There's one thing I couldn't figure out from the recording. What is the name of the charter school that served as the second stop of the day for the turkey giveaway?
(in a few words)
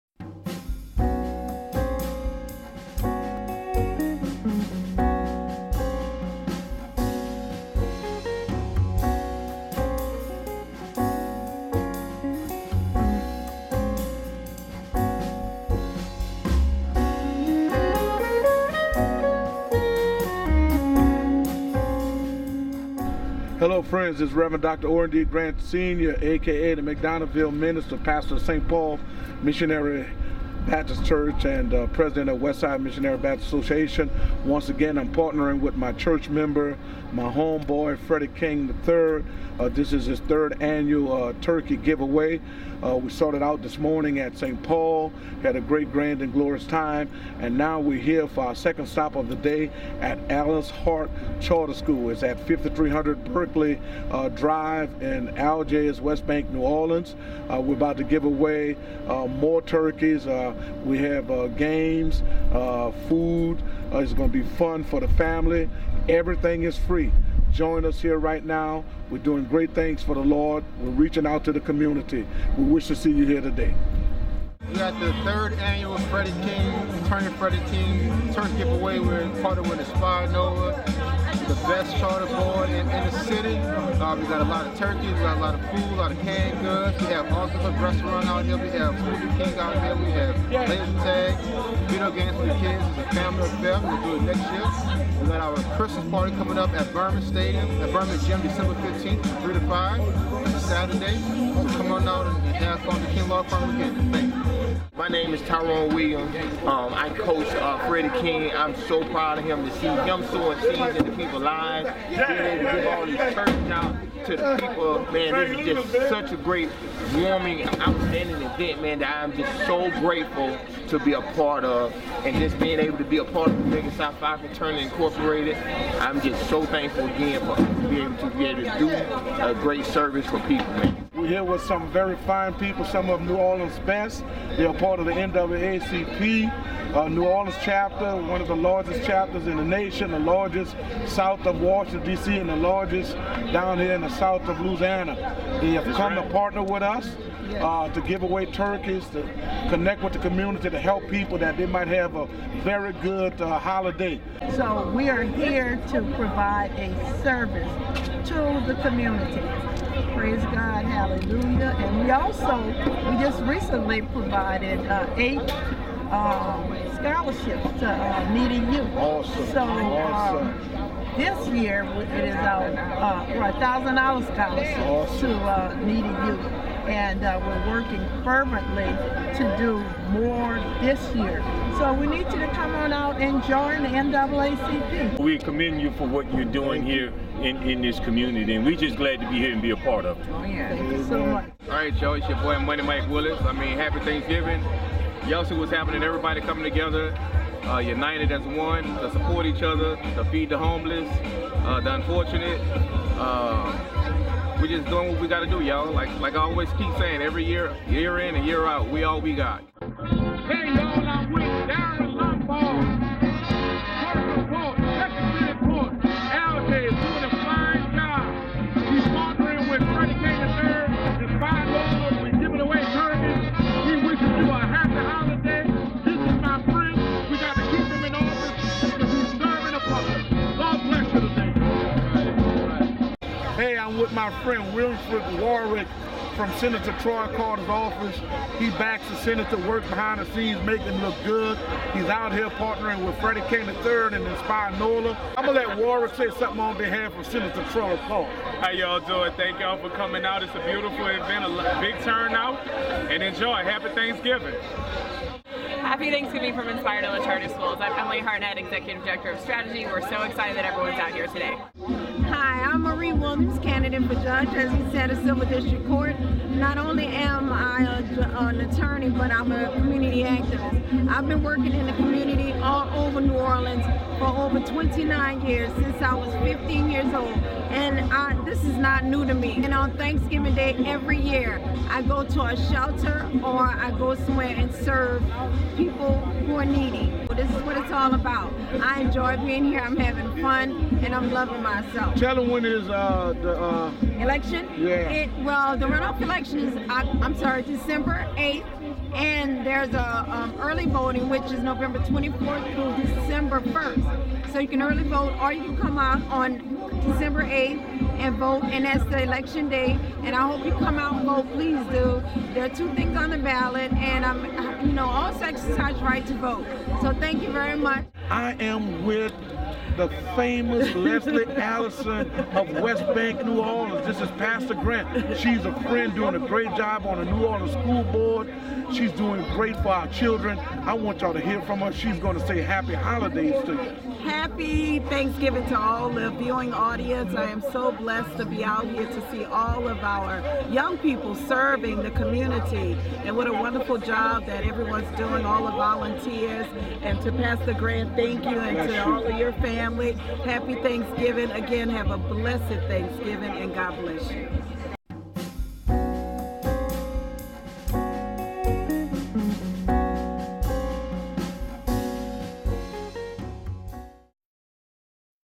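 Alice Harte Charter School.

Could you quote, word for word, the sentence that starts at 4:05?
I'm going to let Warwick say something on behalf of Senator Troy Carter.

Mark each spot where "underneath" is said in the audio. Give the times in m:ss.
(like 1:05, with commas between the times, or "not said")
not said.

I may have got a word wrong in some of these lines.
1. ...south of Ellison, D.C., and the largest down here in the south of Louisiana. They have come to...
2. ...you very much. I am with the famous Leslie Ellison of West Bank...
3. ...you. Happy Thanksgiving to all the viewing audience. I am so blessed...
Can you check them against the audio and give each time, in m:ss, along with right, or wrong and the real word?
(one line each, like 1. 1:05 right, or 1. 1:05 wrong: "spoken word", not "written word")
1. 2:21 wrong: "Washington", not "Ellison"
2. 5:17 right
3. 5:33 right.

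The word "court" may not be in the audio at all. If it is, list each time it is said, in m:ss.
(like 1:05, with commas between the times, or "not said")
4:25.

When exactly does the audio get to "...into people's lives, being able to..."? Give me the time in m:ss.
1:50.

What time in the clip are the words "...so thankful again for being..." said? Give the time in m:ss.
2:06.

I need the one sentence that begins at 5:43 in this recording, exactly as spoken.
And what a wonderful job that everyone's doing, all the volunteers.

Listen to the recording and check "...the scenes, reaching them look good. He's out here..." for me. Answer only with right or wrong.
wrong.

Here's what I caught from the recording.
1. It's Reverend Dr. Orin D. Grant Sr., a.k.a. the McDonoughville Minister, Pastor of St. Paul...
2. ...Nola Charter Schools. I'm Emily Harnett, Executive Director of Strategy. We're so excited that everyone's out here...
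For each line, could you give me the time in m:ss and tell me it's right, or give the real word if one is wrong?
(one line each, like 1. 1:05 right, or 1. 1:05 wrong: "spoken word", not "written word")
1. 0:24 right
2. 4:17 right.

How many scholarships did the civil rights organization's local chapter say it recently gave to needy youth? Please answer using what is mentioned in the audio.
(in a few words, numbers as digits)
8.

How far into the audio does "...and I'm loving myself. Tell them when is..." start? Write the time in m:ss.
4:51.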